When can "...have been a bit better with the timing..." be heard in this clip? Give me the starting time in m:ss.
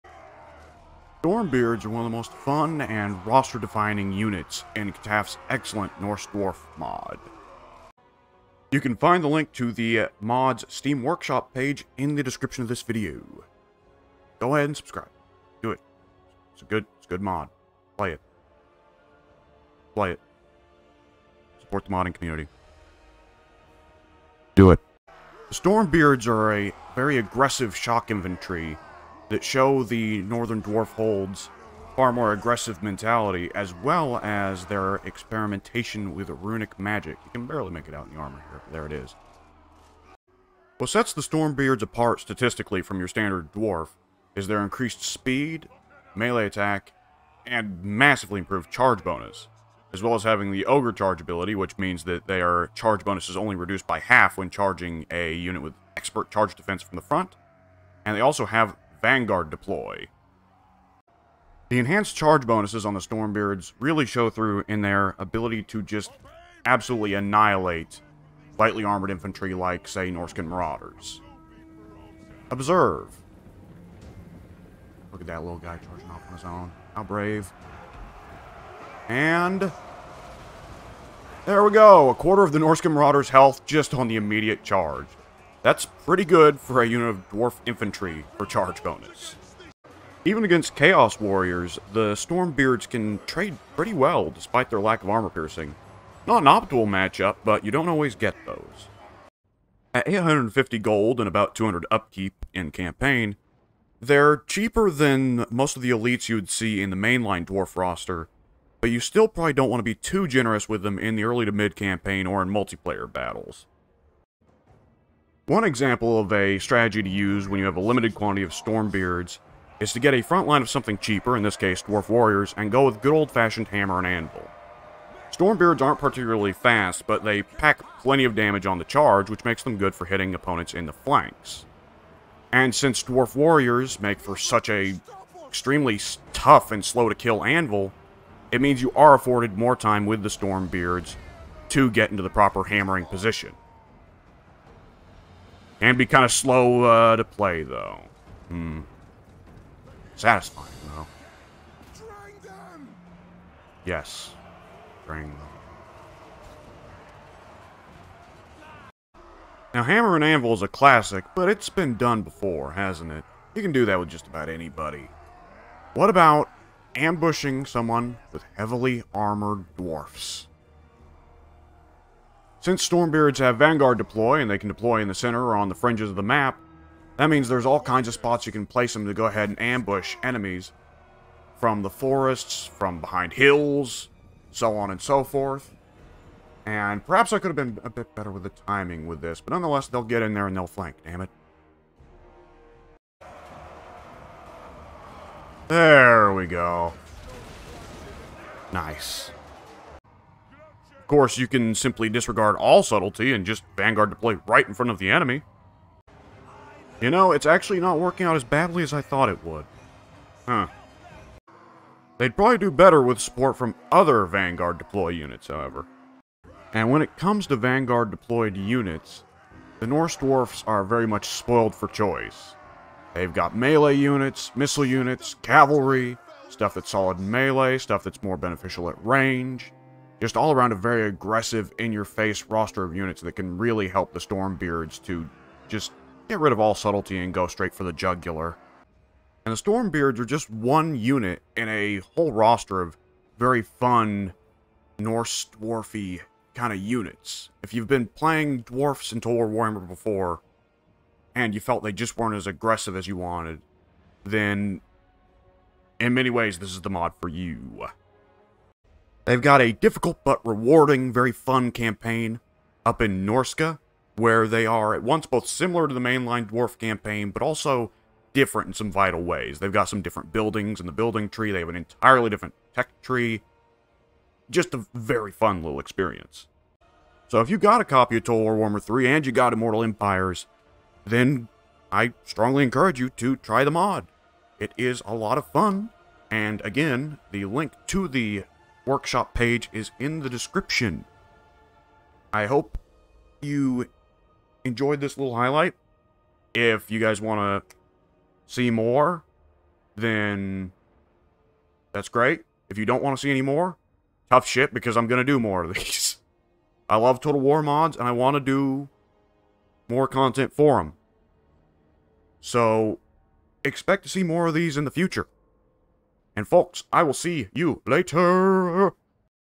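3:07.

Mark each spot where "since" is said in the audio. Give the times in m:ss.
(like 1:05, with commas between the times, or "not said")
2:12, 2:52.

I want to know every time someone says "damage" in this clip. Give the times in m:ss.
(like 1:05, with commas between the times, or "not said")
2:08.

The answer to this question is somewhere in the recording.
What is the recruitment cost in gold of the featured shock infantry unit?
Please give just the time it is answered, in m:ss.
1:40.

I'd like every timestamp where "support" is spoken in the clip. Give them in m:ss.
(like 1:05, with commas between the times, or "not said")
0:21, 3:33.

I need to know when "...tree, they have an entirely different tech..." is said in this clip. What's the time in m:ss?
4:31.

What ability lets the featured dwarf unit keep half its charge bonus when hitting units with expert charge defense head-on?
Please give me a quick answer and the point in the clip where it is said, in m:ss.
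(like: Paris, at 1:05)
Ogre Charge, at 0:50.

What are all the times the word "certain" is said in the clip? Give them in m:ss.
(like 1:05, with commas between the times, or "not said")
not said.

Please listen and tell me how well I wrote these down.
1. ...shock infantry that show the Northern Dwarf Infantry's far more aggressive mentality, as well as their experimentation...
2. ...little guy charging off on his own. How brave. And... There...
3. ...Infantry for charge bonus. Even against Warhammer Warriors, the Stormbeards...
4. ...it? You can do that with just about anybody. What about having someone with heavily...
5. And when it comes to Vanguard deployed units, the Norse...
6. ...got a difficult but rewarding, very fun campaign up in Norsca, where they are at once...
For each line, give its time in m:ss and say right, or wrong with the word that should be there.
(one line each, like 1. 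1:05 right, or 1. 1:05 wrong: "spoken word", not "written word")
1. 0:27 wrong: "Hold", not "Infantry"
2. 1:15 right
3. 1:27 wrong: "Chaos", not "Warhammer"
4. 2:43 wrong: "ambushing", not "having"
5. 3:36 right
6. 4:19 right.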